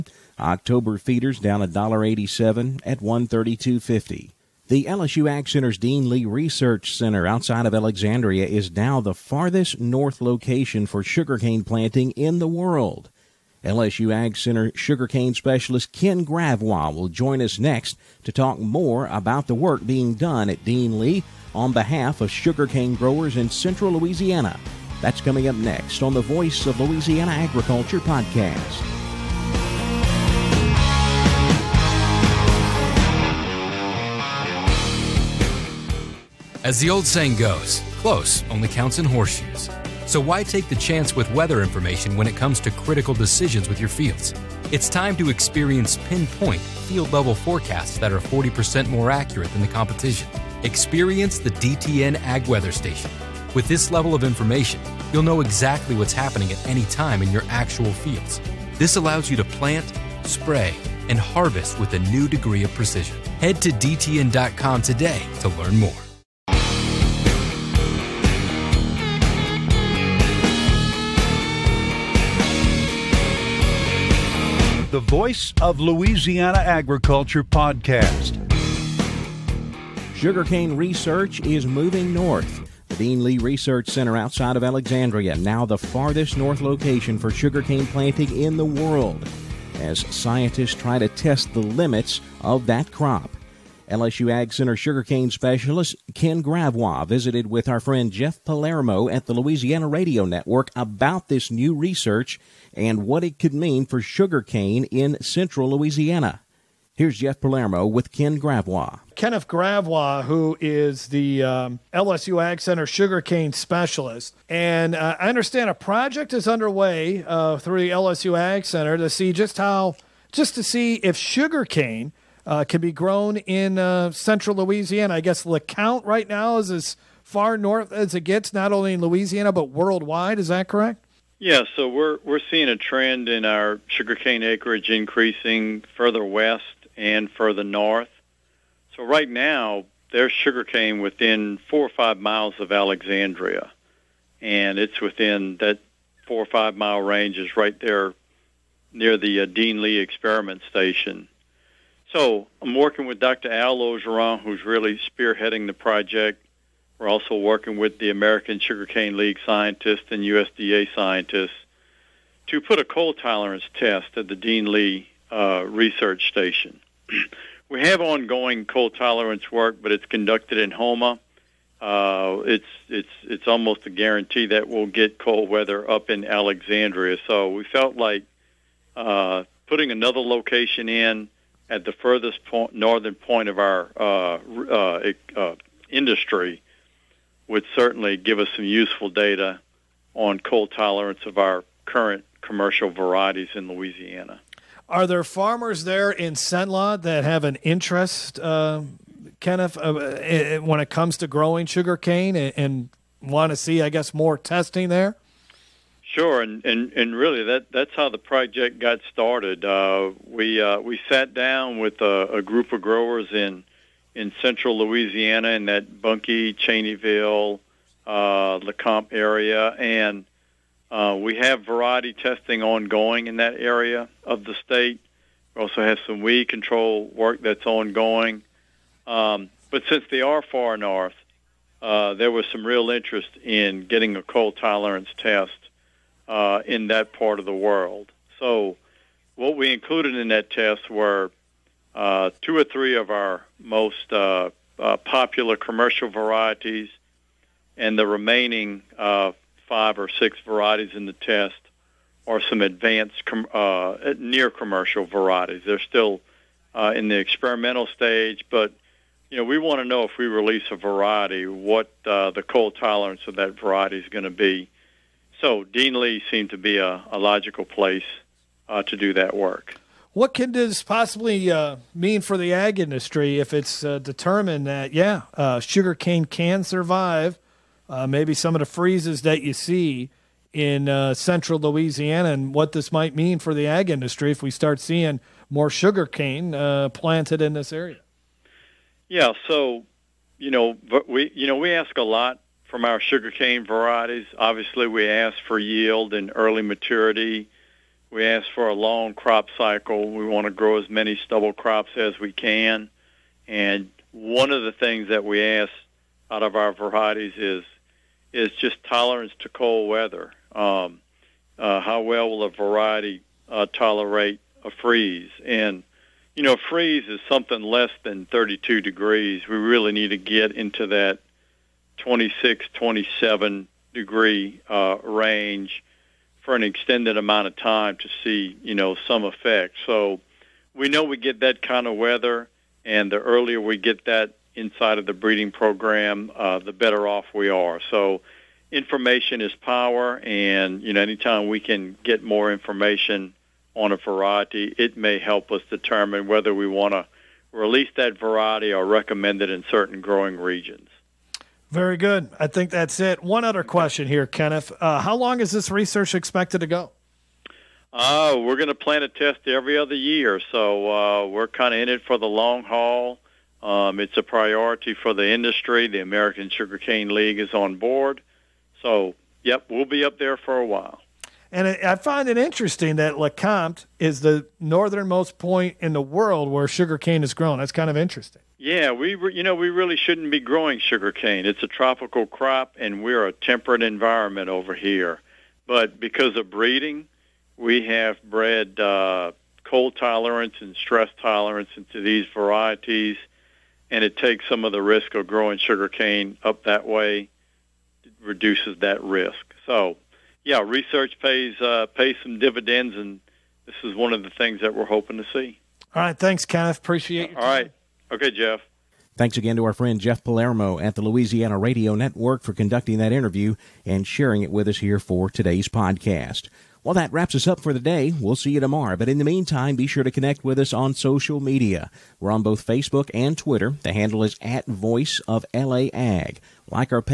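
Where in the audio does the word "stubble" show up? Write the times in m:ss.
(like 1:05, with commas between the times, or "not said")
5:01.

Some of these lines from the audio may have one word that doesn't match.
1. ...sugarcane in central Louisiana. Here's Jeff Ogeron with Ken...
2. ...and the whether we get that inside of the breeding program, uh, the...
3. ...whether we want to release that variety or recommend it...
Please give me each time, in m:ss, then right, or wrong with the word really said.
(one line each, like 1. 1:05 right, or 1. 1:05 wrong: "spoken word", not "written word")
1. 1:44 wrong: "Palermo", not "Ogeron"
2. 5:32 wrong: "earlier", not "whether"
3. 5:46 right.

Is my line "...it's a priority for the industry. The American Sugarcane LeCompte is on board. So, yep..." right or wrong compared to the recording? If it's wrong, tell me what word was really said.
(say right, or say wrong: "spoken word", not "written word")
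wrong: "League", not "LeCompte".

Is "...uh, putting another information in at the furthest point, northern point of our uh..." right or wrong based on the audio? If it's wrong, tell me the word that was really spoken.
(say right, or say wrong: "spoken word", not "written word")
wrong: "location", not "information".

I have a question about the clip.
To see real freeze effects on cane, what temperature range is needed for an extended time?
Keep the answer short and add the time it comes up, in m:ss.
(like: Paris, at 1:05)
26 to 27 degrees, at 5:21.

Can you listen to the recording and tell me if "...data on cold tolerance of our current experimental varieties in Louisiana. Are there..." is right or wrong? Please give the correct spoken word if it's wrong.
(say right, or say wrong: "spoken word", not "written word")
wrong: "commercial", not "experimental".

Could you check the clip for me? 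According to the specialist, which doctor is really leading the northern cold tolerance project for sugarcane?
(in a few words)
Dr. Al Ogeron.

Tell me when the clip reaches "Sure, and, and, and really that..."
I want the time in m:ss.
3:26.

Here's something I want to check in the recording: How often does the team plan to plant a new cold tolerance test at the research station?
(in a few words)
Every other year.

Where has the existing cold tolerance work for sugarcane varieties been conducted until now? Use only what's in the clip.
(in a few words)
Homa.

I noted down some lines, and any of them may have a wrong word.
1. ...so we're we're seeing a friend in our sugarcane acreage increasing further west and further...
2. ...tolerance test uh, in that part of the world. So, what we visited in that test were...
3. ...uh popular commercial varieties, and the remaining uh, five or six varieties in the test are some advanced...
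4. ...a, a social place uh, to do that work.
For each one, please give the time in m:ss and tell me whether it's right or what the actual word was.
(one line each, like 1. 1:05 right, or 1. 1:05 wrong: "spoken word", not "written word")
1. 2:11 wrong: "trend", not "friend"
2. 3:54 wrong: "included", not "visited"
3. 4:04 right
4. 4:26 wrong: "logical", not "social".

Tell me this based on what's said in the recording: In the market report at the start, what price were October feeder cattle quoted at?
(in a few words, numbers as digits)
132.50.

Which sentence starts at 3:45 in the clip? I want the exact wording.
We also have some weed control work that's ongoing.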